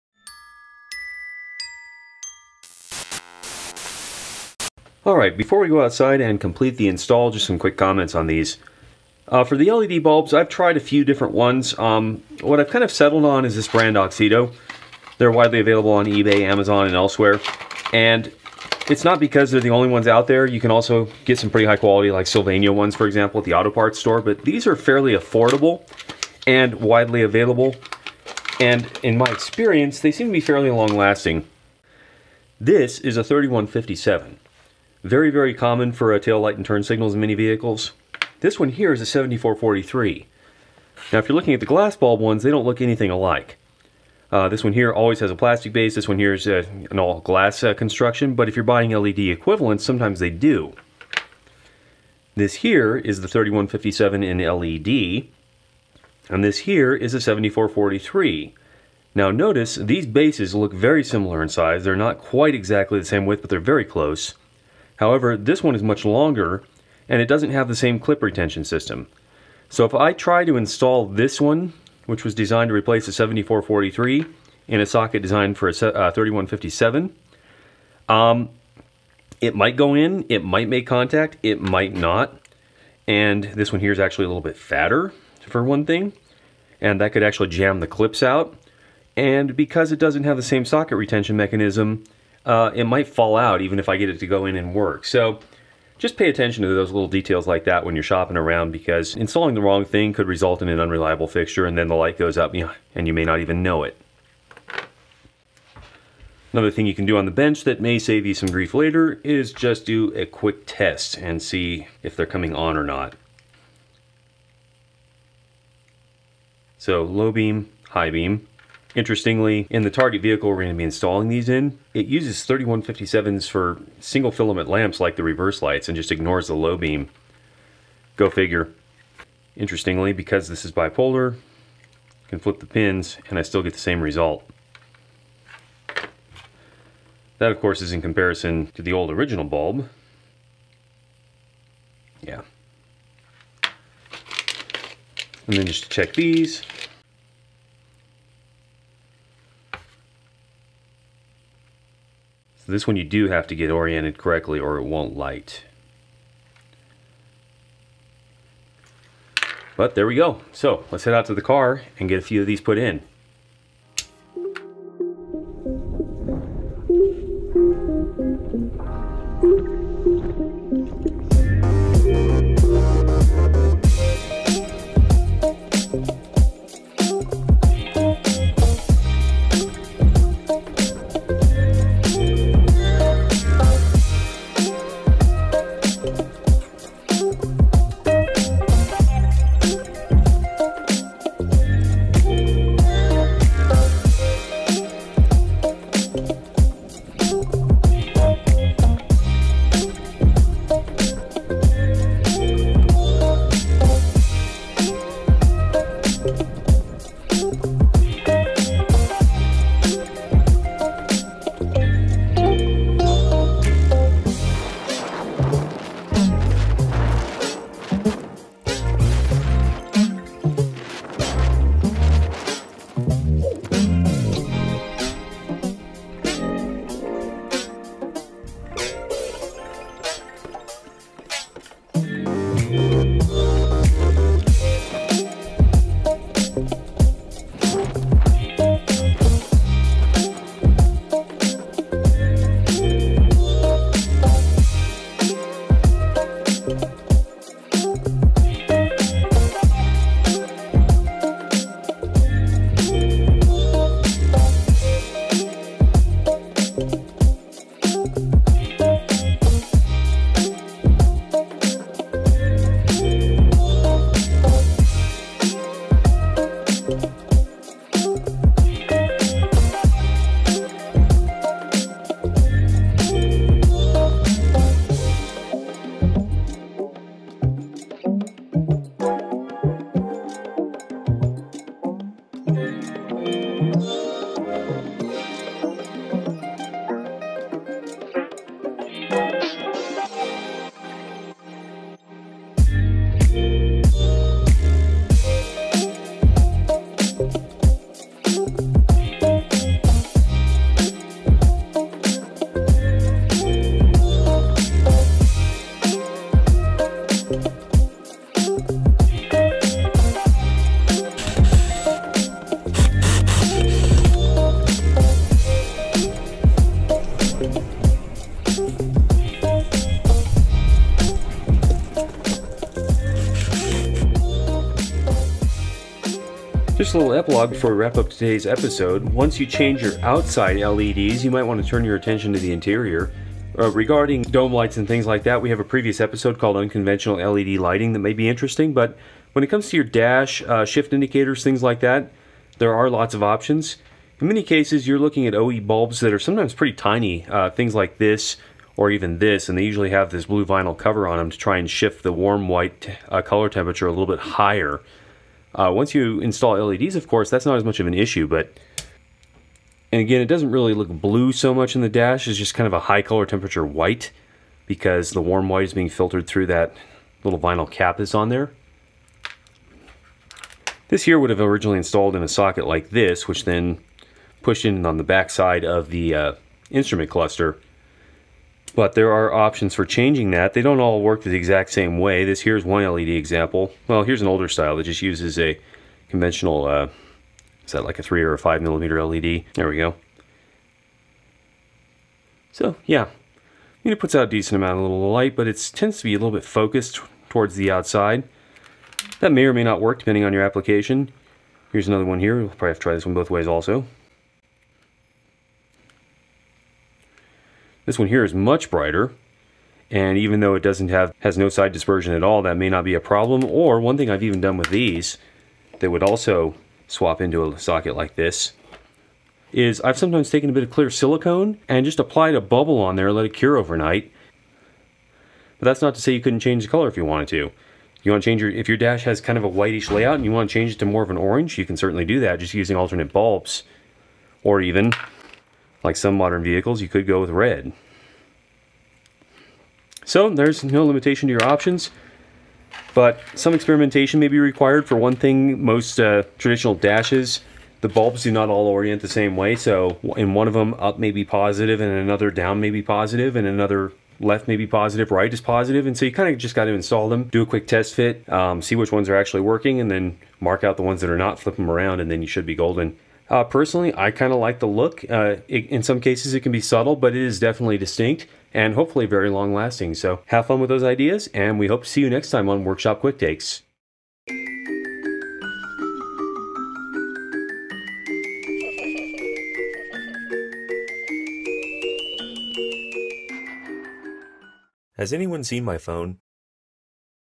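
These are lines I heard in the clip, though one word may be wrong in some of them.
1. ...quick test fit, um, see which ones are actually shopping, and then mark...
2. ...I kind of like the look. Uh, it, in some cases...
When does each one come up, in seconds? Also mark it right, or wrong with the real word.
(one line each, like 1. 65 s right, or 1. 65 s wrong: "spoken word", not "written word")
1. 457 s wrong: "working", not "shopping"
2. 463 s right.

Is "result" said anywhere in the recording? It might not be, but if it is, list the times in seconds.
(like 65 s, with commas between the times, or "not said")
100 s, 134 s.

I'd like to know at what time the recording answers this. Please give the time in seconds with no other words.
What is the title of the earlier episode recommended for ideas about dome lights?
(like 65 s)
336 s.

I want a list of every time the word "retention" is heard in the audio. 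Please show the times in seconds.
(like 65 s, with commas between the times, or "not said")
68 s, 90 s.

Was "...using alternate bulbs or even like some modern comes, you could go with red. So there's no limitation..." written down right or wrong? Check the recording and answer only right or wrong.
wrong.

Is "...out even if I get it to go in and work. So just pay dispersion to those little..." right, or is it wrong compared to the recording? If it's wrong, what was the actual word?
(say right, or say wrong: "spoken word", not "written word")
wrong: "attention", not "dispersion".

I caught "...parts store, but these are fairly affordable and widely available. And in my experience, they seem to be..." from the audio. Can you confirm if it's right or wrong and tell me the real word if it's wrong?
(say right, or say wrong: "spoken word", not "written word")
right.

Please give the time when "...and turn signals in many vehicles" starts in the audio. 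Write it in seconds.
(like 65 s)
36 s.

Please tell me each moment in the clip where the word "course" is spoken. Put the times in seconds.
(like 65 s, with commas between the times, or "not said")
137 s, 357 s.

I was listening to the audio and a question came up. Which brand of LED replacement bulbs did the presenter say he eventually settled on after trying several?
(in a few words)
Auxito.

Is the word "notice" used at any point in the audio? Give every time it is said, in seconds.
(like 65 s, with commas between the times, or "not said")
59 s.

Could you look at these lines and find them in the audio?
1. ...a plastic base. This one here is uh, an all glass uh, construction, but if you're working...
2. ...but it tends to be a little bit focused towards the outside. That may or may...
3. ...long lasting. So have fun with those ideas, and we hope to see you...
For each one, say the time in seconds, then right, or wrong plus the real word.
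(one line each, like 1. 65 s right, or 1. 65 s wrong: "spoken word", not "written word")
1. 45 s wrong: "buying", not "working"
2. 395 s right
3. 469 s right.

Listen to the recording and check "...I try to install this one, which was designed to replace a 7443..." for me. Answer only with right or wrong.
right.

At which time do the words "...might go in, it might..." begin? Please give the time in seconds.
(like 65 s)
79 s.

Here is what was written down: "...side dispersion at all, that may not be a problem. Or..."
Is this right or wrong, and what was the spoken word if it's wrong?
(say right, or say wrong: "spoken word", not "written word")
right.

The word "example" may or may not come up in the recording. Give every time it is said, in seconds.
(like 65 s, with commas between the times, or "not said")
23 s, 383 s.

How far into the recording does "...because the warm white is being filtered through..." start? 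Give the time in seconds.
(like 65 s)
364 s.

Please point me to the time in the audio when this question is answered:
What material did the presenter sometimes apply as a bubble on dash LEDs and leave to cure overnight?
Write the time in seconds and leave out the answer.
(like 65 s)
420 s.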